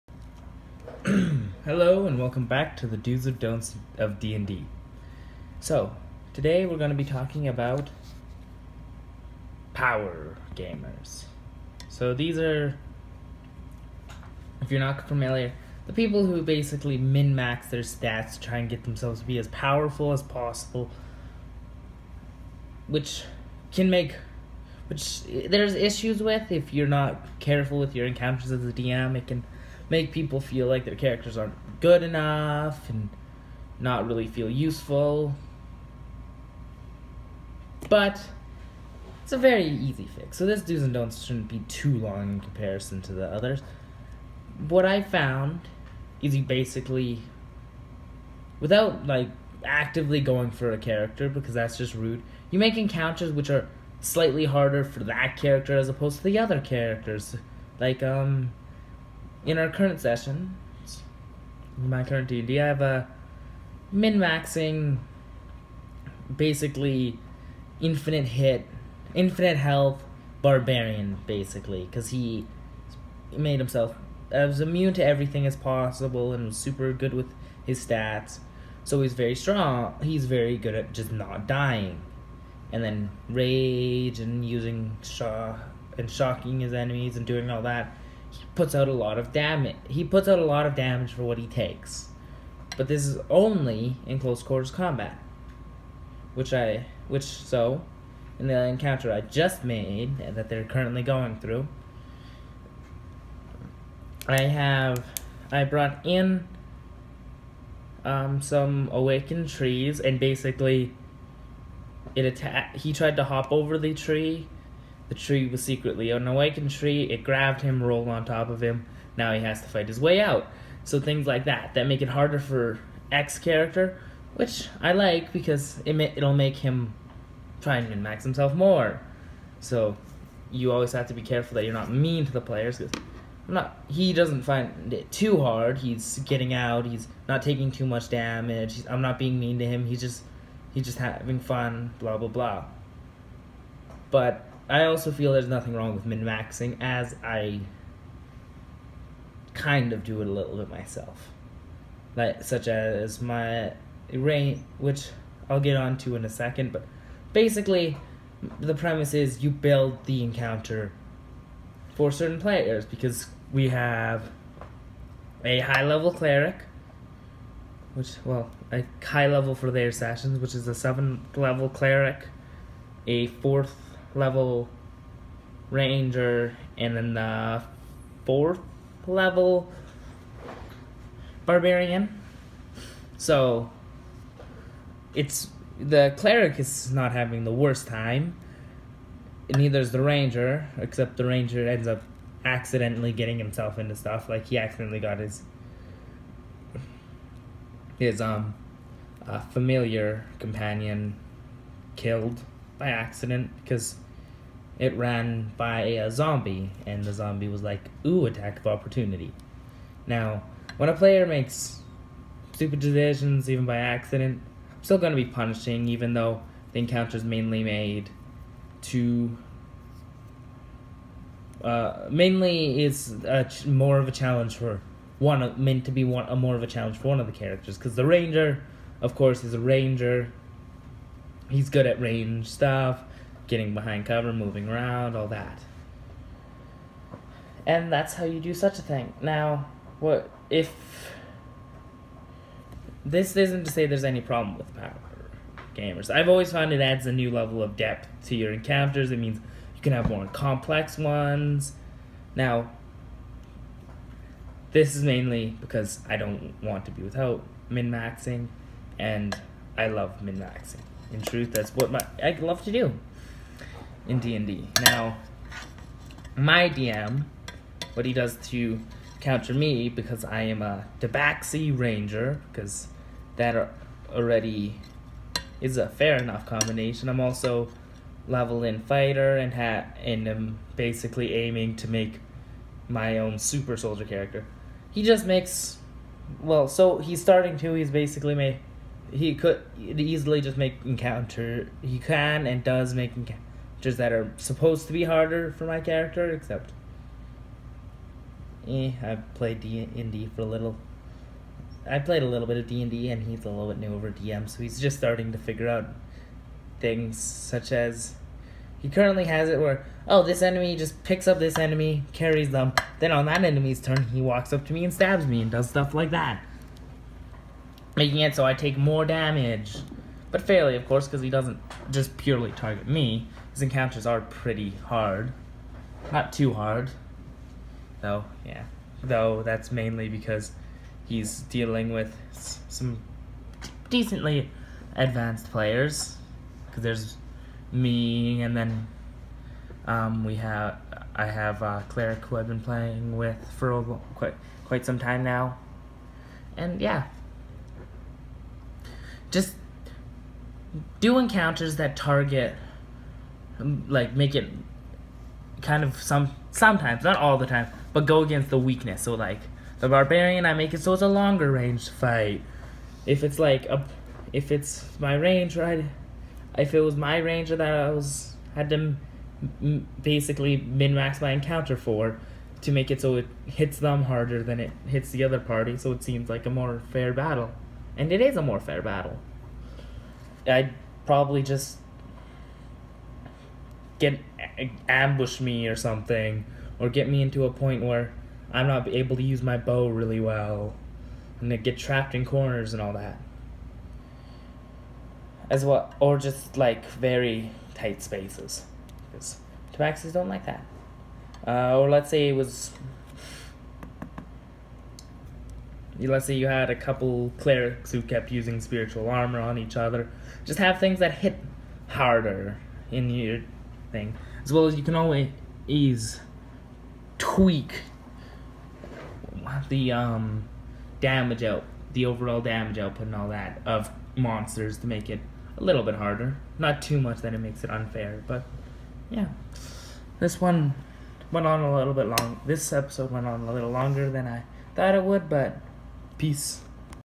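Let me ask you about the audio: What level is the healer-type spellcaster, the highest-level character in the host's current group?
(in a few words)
7th.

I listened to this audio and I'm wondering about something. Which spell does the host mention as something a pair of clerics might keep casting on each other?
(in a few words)
spiritual armor.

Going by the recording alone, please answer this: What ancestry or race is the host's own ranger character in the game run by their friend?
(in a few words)
Tabaxi.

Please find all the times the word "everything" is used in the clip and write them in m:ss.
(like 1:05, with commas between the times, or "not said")
1:15.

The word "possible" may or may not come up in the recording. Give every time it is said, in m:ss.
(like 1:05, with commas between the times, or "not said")
0:20, 1:15.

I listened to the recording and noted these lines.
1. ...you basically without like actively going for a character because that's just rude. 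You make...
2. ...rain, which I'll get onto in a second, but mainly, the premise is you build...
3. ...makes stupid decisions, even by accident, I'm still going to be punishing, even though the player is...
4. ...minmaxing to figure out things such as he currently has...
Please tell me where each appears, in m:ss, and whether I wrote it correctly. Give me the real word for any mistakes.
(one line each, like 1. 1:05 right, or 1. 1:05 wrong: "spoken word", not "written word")
1. 0:46 right
2. 2:34 wrong: "basically", not "mainly"
3. 3:31 wrong: "encounter", not "player"
4. 5:04 wrong: "starting", not "minmaxing".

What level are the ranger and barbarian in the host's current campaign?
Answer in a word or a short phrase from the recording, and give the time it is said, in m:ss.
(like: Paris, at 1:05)
4th, at 2:53.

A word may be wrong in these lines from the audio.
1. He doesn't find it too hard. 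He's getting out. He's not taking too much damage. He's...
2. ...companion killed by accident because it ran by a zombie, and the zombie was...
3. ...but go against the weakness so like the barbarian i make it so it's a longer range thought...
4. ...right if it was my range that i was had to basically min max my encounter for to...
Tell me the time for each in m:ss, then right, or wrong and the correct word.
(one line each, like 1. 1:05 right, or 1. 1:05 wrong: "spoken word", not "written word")
1. 2:13 right
2. 3:20 right
3. 5:57 wrong: "fight", not "thought"
4. 6:05 right.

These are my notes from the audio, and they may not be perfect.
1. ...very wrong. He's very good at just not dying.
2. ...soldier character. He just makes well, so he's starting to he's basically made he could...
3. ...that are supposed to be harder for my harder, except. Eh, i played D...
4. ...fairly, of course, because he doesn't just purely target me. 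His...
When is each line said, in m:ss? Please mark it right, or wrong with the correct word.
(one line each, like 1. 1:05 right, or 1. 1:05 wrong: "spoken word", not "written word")
1. 1:19 wrong: "strong", not "wrong"
2. 4:43 right
3. 4:53 wrong: "character", not "harder"
4. 5:20 right.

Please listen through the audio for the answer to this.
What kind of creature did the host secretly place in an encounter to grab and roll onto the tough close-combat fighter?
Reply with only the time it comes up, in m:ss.
1:48.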